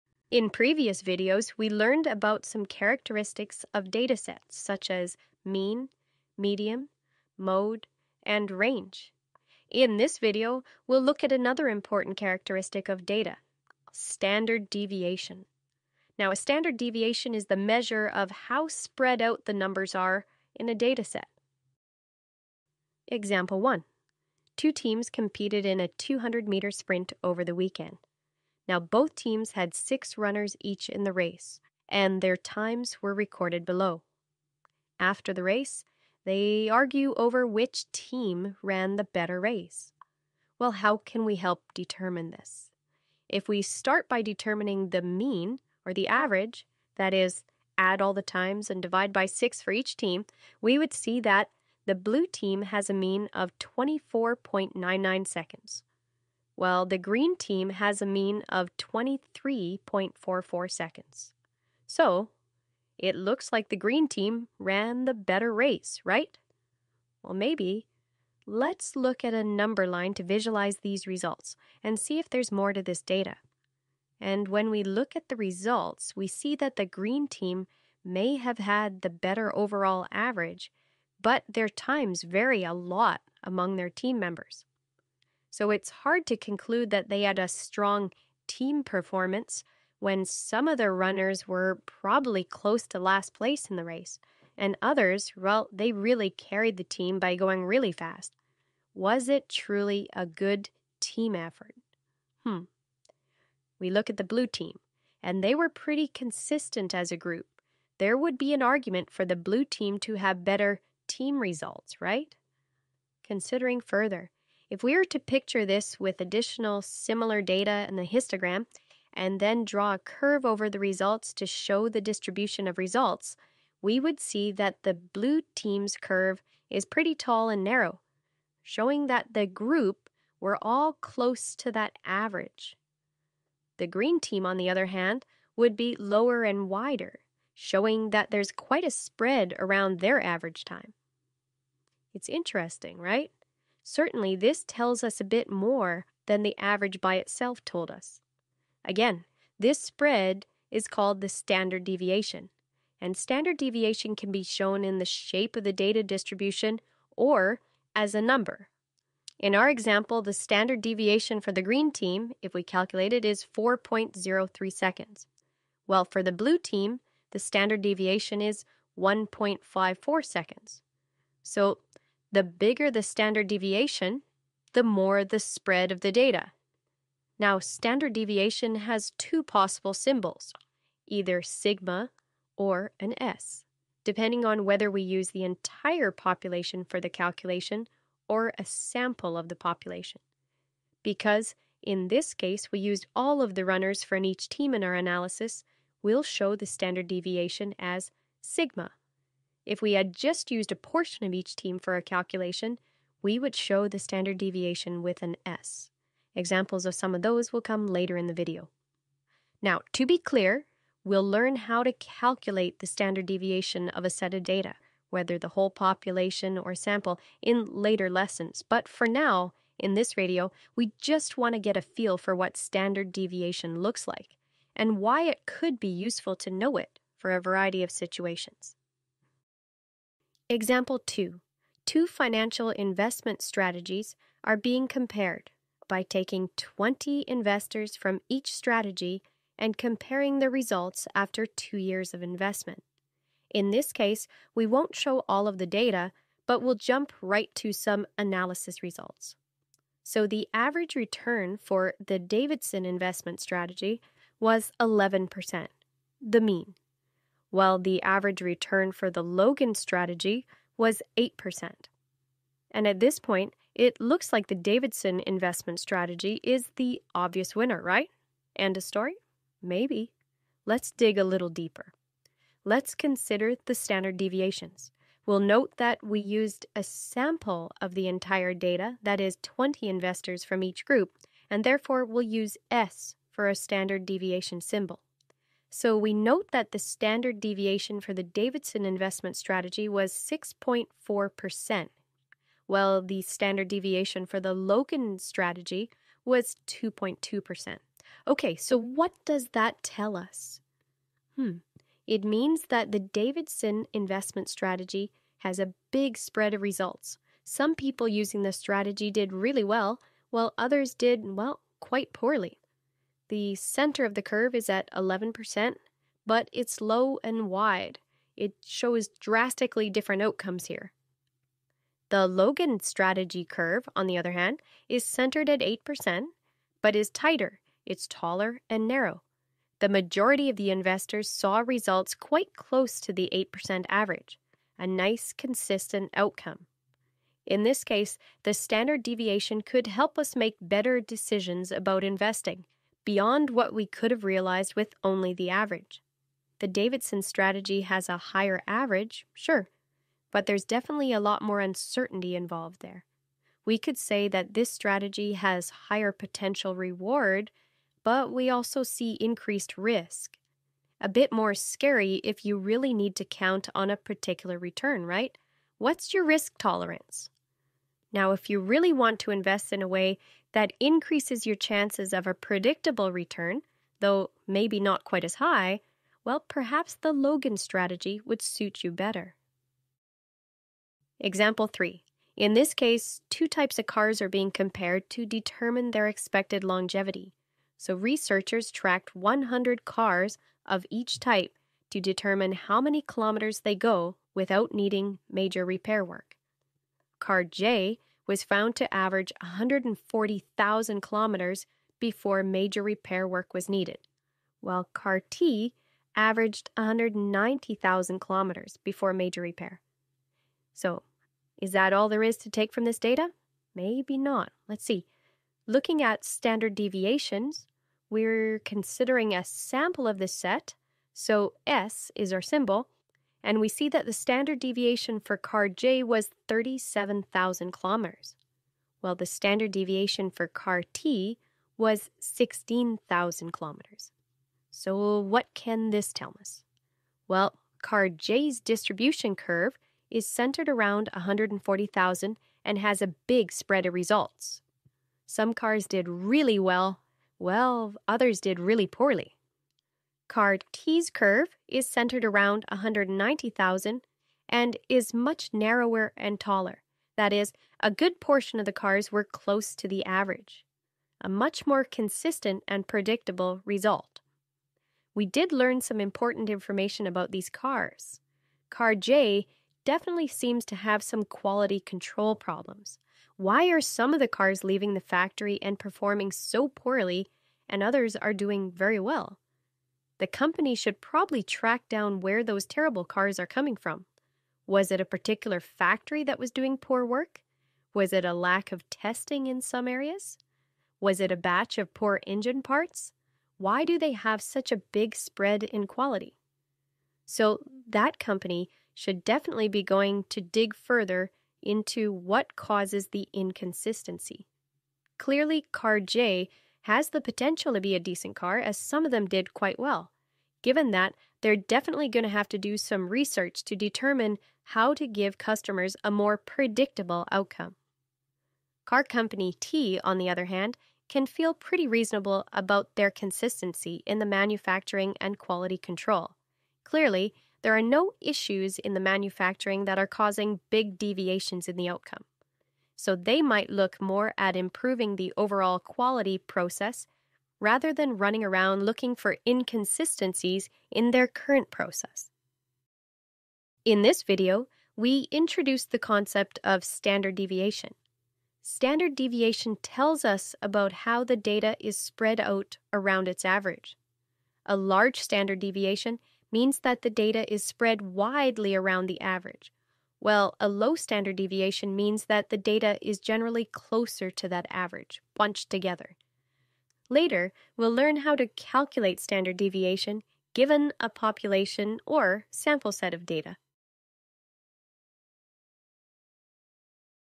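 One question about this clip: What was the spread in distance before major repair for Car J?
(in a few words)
37,000 kilometers.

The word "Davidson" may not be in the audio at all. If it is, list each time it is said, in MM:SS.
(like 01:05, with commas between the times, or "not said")
04:12, 04:24, 04:48, 05:02, 05:46.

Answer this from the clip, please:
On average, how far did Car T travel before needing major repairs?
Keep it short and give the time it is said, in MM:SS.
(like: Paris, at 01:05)
190,000 kilometers, at 06:46.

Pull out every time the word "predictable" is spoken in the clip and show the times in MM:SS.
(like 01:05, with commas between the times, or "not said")
06:12, 07:42, 08:36.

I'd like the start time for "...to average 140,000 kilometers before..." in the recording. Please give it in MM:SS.
06:38.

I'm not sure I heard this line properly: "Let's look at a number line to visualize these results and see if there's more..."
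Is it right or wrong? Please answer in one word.
right.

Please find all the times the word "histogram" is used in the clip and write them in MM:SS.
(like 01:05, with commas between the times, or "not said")
01:58.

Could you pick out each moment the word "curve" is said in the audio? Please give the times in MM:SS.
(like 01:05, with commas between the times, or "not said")
01:59, 02:05, 05:14, 05:23, 07:19, 07:31.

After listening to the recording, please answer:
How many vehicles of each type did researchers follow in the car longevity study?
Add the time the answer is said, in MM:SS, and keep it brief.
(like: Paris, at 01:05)
100, at 06:29.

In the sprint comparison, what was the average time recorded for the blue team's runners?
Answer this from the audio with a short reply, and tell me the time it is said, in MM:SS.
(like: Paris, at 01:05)
24.99 seconds, at 00:53.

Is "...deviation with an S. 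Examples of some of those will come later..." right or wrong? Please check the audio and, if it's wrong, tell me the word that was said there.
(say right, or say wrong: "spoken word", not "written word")
right.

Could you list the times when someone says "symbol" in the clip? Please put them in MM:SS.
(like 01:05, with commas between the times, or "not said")
02:59, 04:44, 07:02.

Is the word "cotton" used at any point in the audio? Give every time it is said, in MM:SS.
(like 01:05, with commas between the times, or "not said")
not said.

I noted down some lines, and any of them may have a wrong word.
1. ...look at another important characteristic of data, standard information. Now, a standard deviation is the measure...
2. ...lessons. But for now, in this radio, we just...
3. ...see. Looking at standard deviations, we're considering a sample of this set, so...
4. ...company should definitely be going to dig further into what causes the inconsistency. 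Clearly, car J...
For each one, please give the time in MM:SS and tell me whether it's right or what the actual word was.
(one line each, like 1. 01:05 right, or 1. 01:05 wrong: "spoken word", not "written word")
1. 00:11 wrong: "deviation", not "information"
2. 03:38 right
3. 06:54 right
4. 08:18 right.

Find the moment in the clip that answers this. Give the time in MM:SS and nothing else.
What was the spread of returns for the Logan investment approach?
04:56.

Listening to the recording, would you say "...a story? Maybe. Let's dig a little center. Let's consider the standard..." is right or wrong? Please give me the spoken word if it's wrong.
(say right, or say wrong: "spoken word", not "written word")
wrong: "deeper", not "center".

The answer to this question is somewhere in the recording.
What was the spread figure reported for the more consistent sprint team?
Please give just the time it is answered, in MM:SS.
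02:48.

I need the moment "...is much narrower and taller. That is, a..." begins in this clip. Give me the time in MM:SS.
07:34.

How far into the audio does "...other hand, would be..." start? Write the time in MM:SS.
02:14.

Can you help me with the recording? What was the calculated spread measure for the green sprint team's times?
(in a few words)
4.03 seconds.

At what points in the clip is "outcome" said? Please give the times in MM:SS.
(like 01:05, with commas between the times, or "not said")
05:20, 05:36, 08:37, 08:51.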